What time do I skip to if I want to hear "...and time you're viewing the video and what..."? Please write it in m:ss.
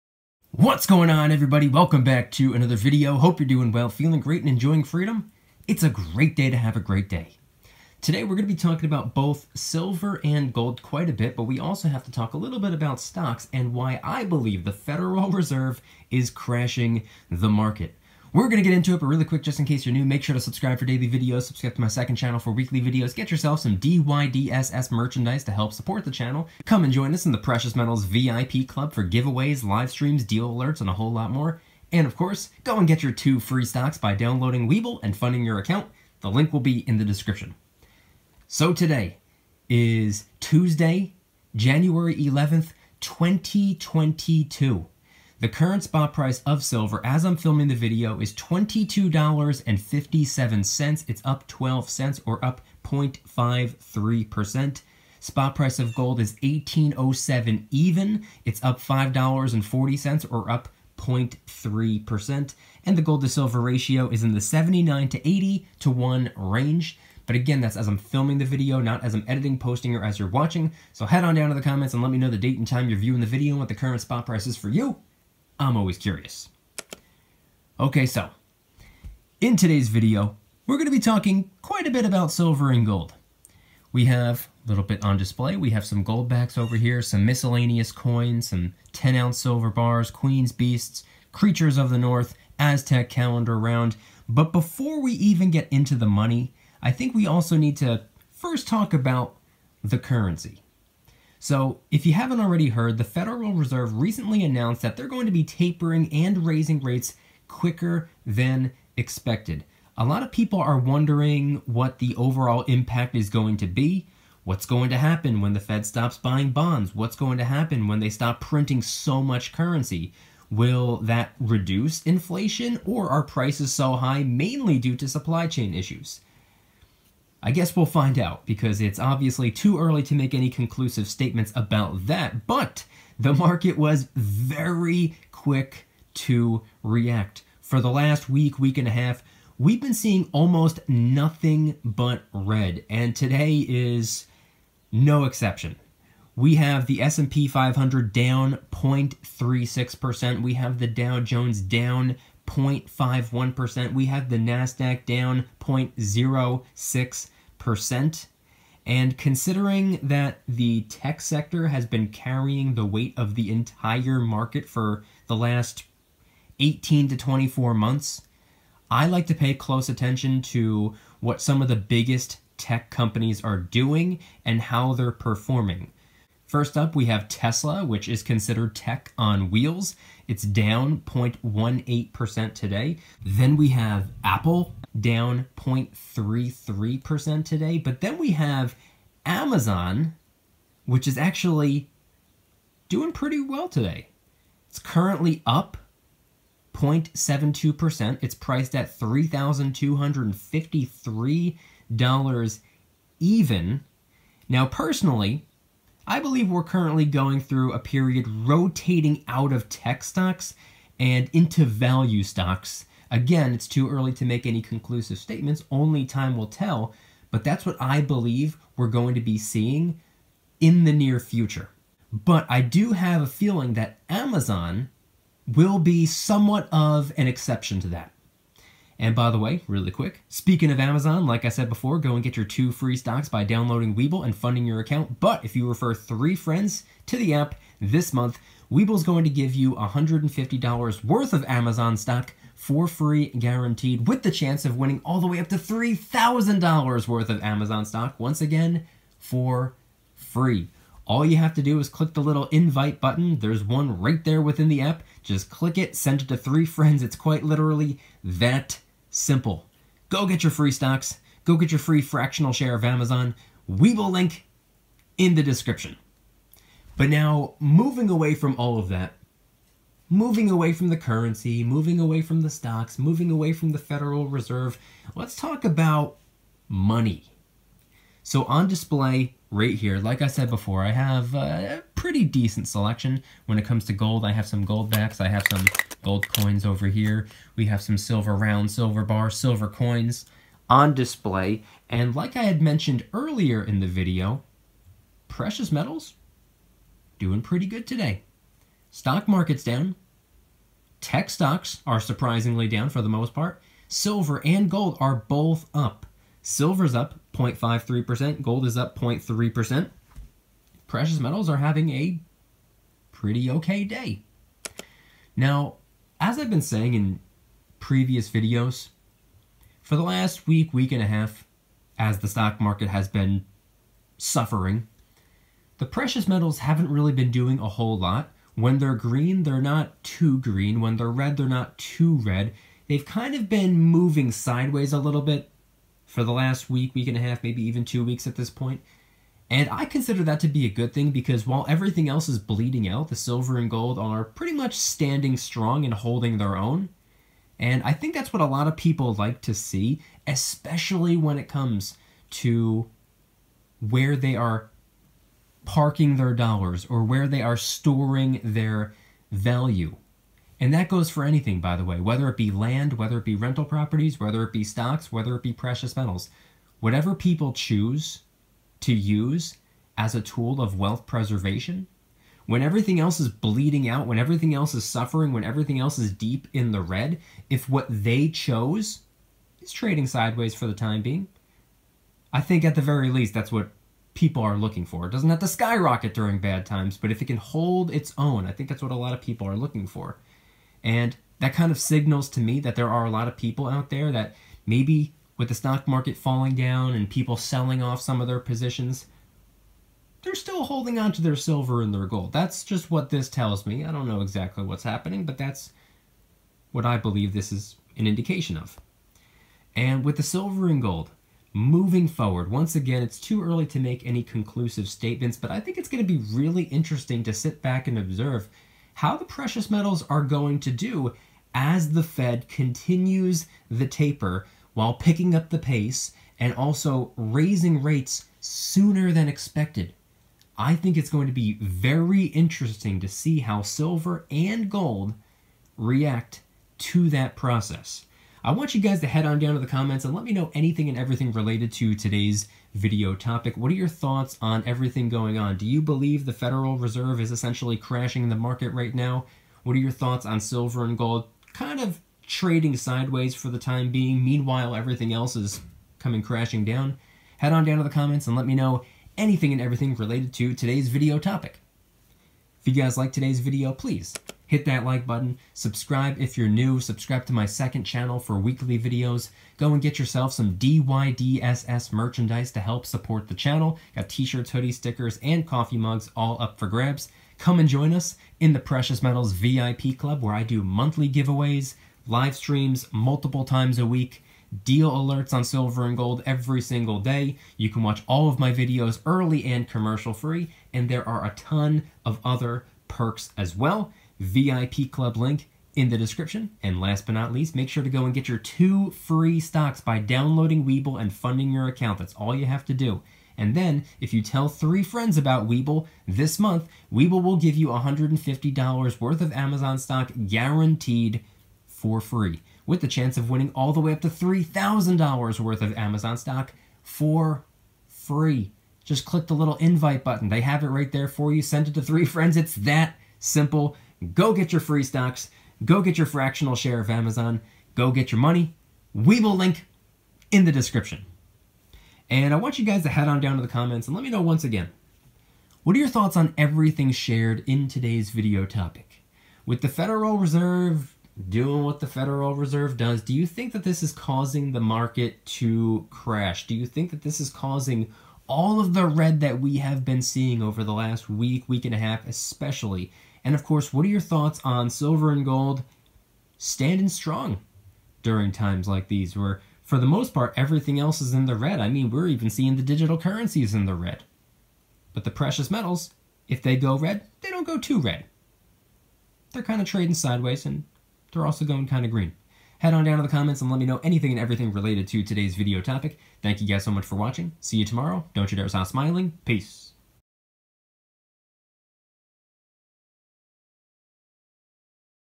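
1:12.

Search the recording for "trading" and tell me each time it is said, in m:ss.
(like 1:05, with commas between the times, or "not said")
6:19, 7:32, 9:29.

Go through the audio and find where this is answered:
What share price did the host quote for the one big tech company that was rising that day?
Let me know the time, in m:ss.
3:18.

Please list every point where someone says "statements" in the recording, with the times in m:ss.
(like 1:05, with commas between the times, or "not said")
2:11, 3:35, 6:54.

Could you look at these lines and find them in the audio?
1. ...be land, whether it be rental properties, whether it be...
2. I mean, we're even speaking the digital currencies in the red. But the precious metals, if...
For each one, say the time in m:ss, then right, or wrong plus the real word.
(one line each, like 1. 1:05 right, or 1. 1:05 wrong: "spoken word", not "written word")
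1. 6:02 right
2. 9:21 wrong: "seeing", not "speaking".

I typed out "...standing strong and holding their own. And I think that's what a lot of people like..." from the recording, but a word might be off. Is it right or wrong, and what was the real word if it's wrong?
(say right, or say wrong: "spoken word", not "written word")
right.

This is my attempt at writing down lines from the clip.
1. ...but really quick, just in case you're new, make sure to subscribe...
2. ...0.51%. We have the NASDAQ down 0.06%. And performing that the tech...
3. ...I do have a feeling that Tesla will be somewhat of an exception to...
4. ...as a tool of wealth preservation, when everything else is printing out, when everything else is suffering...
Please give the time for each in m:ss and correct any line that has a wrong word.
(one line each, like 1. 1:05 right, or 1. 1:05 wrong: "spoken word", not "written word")
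1. 0:19 right
2. 2:32 wrong: "considering", not "performing"
3. 3:42 wrong: "Amazon", not "Tesla"
4. 6:09 wrong: "bleeding", not "printing".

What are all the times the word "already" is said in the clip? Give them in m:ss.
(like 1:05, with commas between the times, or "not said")
1:42.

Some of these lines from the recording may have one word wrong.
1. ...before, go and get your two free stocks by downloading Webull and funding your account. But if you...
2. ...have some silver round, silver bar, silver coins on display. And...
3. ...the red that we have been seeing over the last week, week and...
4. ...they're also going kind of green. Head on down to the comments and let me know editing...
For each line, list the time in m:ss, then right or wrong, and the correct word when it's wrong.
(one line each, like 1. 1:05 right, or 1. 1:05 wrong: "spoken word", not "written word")
1. 3:51 right
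2. 4:47 right
3. 9:08 right
4. 9:31 wrong: "anything", not "editing".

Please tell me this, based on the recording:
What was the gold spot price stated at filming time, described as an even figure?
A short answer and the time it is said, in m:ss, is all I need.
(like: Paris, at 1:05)
1807, at 0:56.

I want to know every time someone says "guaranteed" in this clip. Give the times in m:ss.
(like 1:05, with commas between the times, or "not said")
4:03, 8:30.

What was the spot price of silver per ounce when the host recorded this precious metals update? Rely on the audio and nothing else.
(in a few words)
$22.57.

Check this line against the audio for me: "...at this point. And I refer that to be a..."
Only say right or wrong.
wrong.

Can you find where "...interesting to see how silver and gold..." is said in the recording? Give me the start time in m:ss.
7:12.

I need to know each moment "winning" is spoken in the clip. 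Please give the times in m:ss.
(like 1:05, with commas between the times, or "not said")
4:04, 8:33.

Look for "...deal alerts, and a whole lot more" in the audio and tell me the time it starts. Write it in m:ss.
0:30.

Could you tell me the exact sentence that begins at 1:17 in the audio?
Okay, so in today's video, we're going to be talking quite a bit about silver and gold.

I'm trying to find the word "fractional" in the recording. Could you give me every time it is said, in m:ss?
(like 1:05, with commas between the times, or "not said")
4:22, 8:46.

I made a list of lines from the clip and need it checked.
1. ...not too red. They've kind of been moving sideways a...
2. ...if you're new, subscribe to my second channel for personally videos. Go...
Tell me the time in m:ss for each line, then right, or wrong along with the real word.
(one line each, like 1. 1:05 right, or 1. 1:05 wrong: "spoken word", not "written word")
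1. 5:31 right
2. 7:46 wrong: "weekly", not "personally".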